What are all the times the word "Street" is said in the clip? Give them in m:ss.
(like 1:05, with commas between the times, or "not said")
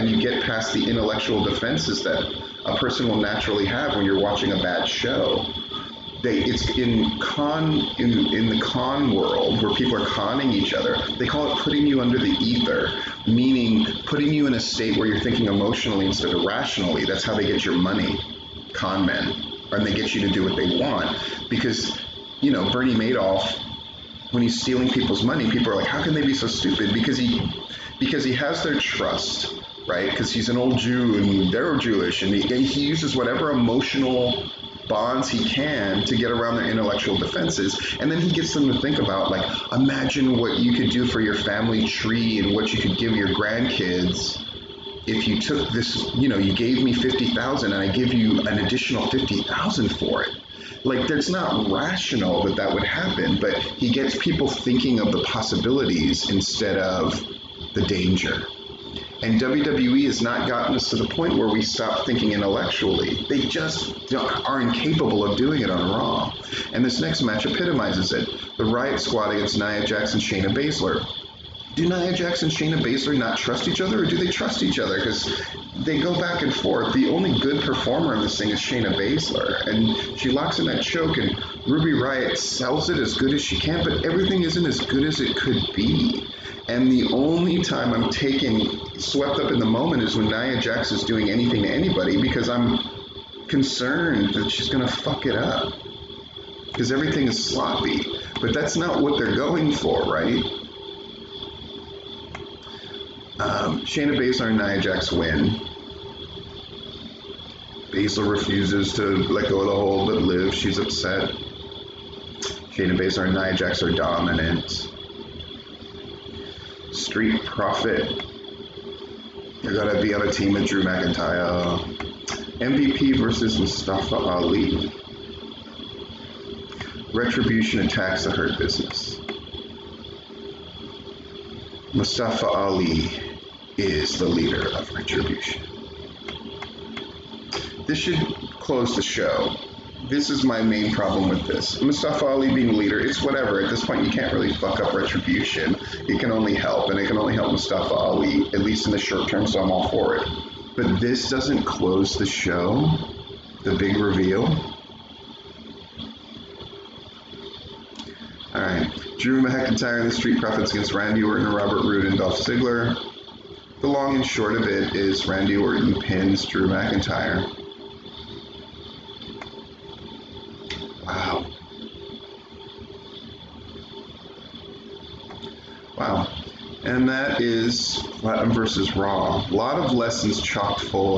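1:56, 2:40.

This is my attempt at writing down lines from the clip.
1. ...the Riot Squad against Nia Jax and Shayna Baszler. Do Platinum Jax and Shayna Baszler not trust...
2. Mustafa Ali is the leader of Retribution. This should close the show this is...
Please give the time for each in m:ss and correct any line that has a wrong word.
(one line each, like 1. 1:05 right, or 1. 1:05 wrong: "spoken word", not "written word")
1. 1:08 wrong: "Nia", not "Platinum"
2. 2:11 right.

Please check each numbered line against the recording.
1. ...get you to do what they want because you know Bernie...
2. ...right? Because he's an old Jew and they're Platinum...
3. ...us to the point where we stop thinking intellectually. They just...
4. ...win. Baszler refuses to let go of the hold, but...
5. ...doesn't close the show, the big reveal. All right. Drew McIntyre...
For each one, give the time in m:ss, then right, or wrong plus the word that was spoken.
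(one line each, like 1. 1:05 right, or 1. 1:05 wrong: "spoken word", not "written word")
1. 0:19 right
2. 0:29 wrong: "Jewish", not "Platinum"
3. 1:00 right
4. 1:45 right
5. 2:31 right.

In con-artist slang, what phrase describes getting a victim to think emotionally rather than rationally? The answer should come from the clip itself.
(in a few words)
putting you under the ether.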